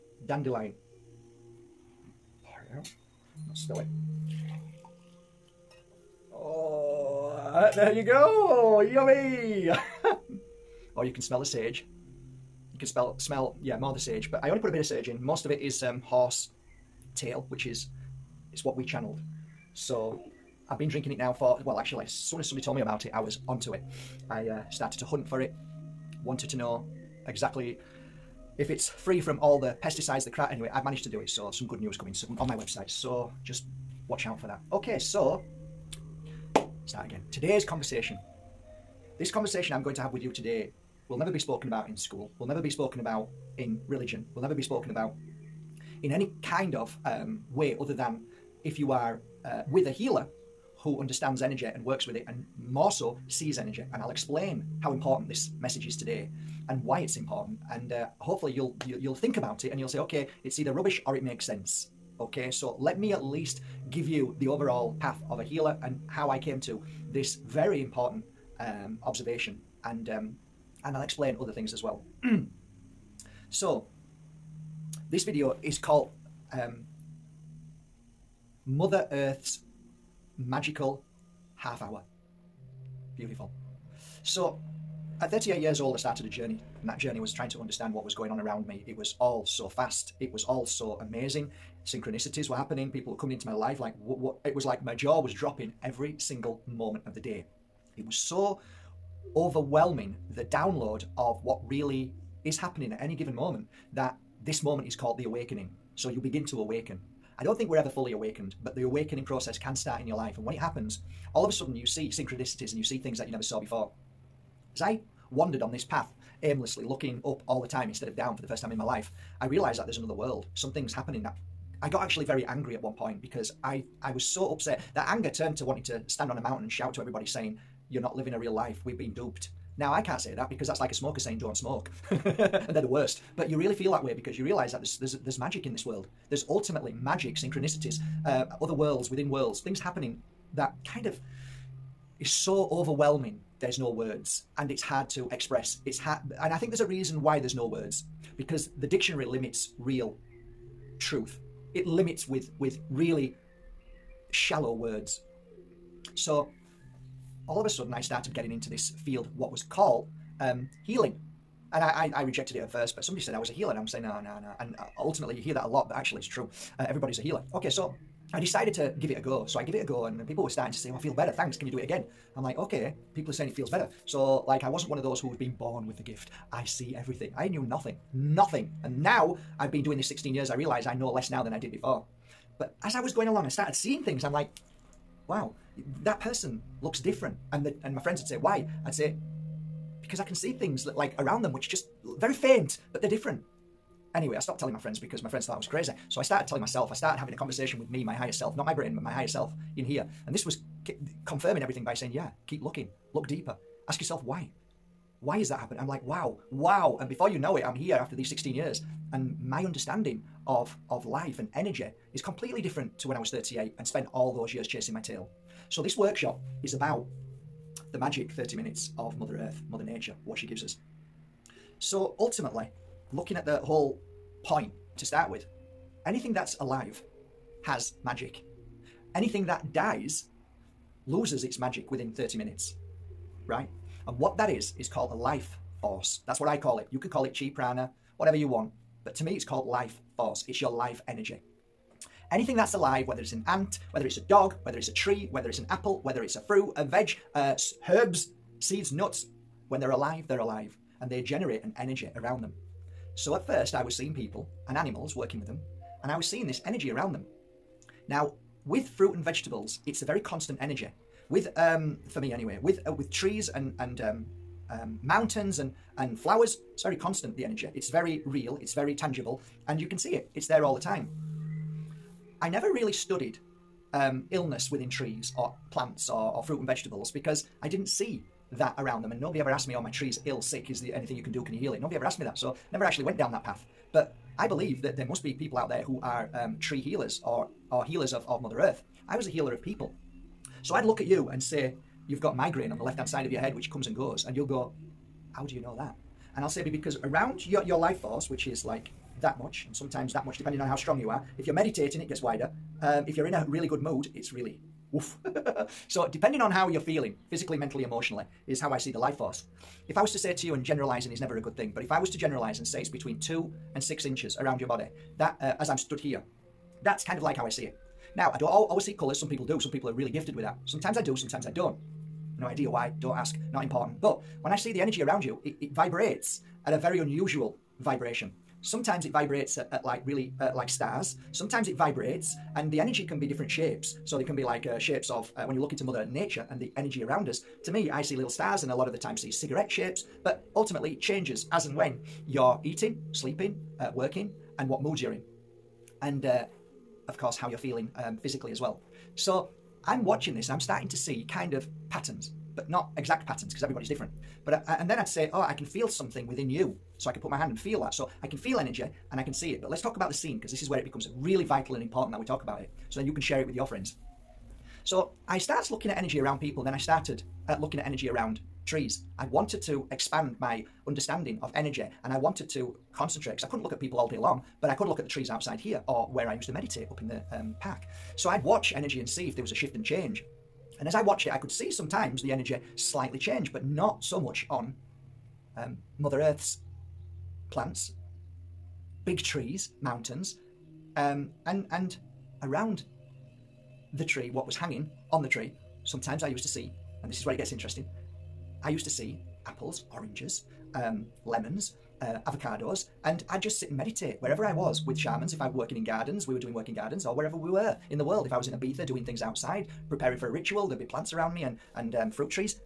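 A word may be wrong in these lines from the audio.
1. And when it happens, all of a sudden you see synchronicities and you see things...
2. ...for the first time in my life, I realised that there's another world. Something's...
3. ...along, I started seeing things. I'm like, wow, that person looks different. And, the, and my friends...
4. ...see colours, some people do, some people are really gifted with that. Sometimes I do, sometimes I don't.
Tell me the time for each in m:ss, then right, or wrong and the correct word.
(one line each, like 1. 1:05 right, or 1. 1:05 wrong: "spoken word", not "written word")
1. 1:50 right
2. 1:58 right
3. 3:03 right
4. 5:18 right.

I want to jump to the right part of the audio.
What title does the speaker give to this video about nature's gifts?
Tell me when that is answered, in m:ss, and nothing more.
1:18.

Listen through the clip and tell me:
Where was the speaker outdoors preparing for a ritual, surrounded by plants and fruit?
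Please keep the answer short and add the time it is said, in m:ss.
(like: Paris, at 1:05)
Ibiza, at 6:48.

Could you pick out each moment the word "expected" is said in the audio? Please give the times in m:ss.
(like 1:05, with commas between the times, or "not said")
not said.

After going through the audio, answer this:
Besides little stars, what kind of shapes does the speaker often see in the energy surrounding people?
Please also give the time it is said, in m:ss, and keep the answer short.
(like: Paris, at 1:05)
cigarette shapes, at 5:39.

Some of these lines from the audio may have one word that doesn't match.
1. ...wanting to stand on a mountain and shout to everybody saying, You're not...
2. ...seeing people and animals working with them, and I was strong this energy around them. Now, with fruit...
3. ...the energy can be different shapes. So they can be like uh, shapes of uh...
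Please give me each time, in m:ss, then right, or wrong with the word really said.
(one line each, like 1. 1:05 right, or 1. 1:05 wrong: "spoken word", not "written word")
1. 2:05 right
2. 4:13 wrong: "seeing", not "strong"
3. 5:32 right.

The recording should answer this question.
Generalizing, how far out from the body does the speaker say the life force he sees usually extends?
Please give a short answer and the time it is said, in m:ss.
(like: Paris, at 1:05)
2 to 6 inches, at 5:13.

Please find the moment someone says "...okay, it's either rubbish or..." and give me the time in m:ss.
0:59.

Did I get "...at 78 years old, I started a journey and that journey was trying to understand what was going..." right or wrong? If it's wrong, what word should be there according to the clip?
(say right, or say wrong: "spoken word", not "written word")
wrong: "38", not "78".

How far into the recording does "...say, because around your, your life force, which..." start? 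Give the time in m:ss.
4:56.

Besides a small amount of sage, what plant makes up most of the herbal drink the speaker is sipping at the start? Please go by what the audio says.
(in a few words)
horse tail.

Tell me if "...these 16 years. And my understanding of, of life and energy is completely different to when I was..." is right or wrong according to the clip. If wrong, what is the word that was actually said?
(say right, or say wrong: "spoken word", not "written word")
right.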